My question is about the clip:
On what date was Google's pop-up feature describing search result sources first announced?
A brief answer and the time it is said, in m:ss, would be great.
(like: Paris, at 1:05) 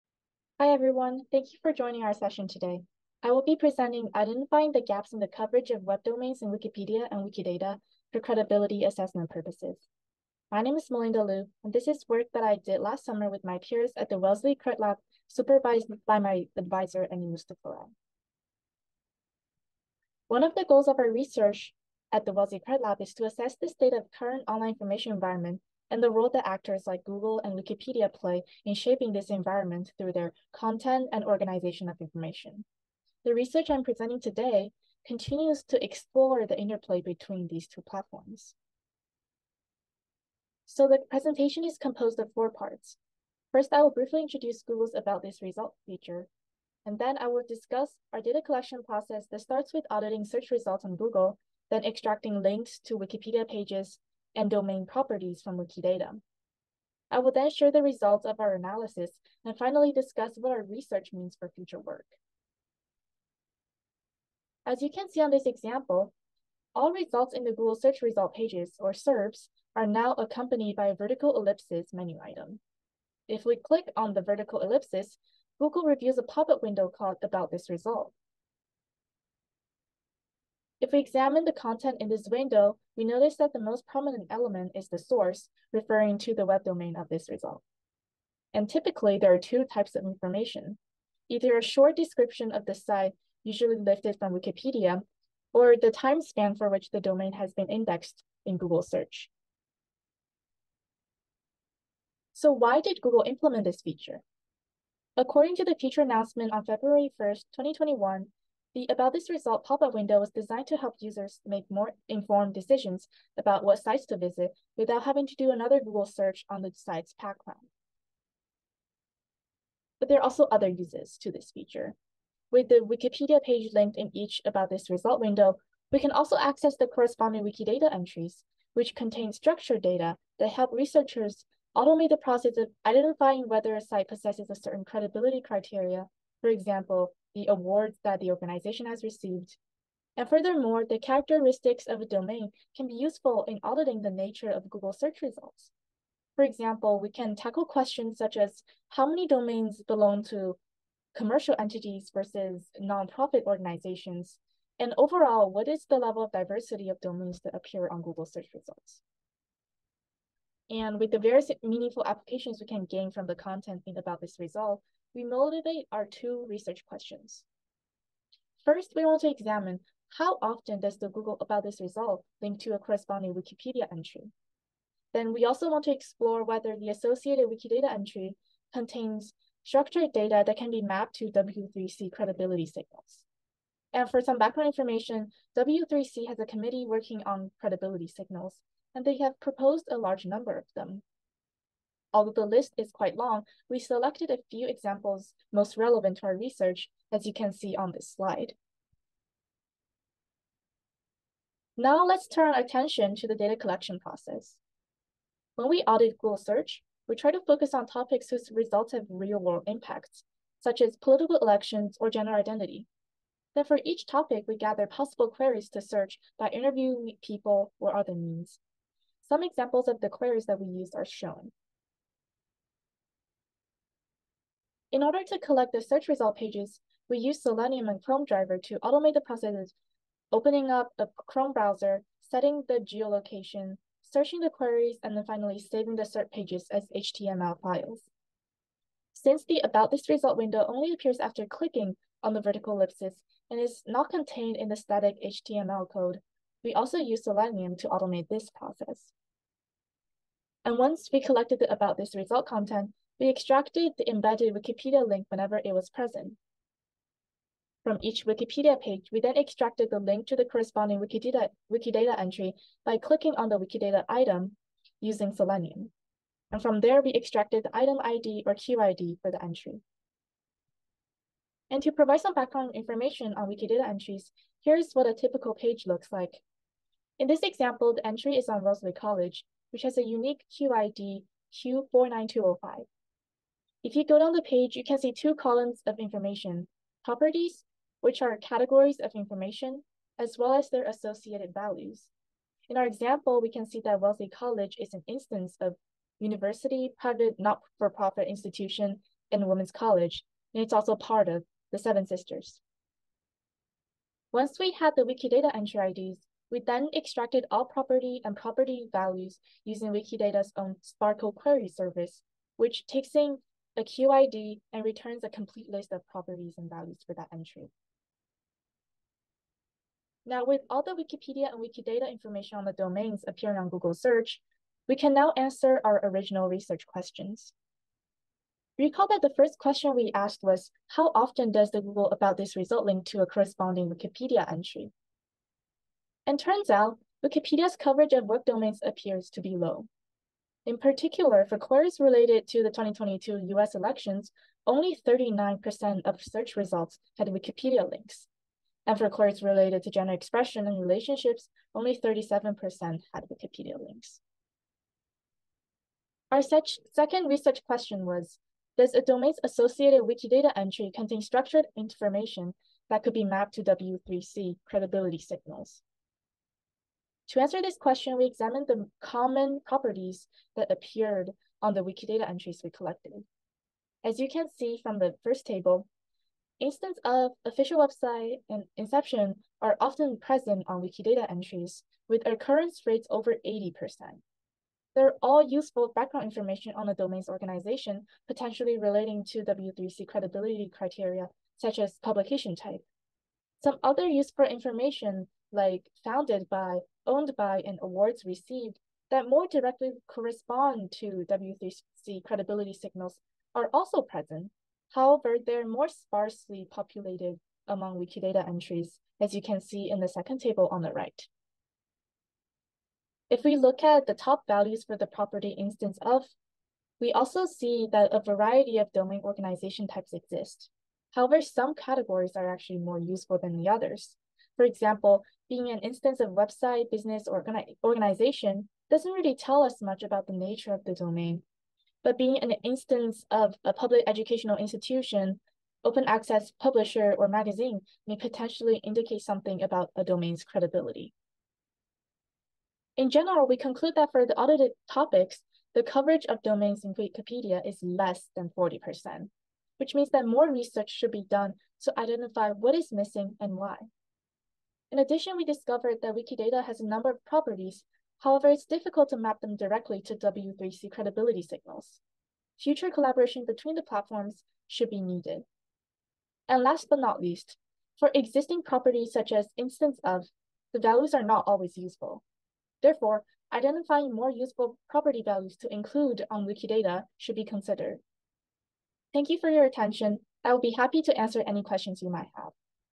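February 1st, 2021, at 1:46.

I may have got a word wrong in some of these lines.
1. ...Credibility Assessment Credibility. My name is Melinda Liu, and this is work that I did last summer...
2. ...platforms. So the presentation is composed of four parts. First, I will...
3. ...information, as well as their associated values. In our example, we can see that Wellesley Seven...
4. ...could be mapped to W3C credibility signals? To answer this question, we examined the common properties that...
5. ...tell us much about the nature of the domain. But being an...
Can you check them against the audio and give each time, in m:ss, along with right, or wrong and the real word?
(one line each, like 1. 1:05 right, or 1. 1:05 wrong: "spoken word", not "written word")
1. 0:08 wrong: "Purposes", not "Credibility"
2. 0:37 right
3. 4:49 wrong: "College", not "Seven"
4. 6:03 right
5. 7:09 right.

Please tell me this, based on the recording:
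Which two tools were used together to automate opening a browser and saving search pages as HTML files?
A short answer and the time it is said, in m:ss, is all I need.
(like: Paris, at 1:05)
Selenium and Chrome driver, at 3:47.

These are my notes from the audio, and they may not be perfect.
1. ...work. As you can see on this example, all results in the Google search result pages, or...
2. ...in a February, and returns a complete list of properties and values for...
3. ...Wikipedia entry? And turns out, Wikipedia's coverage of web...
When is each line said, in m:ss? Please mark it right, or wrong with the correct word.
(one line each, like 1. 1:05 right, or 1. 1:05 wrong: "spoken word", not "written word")
1. 1:01 right
2. 5:13 wrong: "QID", not "February"
3. 5:33 right.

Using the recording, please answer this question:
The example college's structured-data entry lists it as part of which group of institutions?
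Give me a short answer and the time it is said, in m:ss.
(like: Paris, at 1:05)
Seven Sisters, at 5:01.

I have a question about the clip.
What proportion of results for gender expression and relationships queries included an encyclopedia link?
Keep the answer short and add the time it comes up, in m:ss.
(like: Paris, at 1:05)
37%, at 5:51.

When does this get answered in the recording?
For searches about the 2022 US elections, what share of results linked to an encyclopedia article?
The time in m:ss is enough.
5:44.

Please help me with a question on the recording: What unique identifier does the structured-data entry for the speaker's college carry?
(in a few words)
Q49205.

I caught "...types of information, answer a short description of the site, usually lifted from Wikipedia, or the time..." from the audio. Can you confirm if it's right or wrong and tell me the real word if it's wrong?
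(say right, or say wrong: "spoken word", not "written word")
wrong: "either", not "answer".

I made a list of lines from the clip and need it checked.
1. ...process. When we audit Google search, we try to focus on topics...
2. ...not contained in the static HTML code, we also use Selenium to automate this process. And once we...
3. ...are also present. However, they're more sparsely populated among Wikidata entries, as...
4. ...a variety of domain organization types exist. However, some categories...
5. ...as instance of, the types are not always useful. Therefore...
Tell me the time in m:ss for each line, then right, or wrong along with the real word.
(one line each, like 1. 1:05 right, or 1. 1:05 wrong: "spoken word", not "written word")
1. 3:23 right
2. 4:03 right
3. 6:43 right
4. 6:58 right
5. 7:49 wrong: "values", not "types".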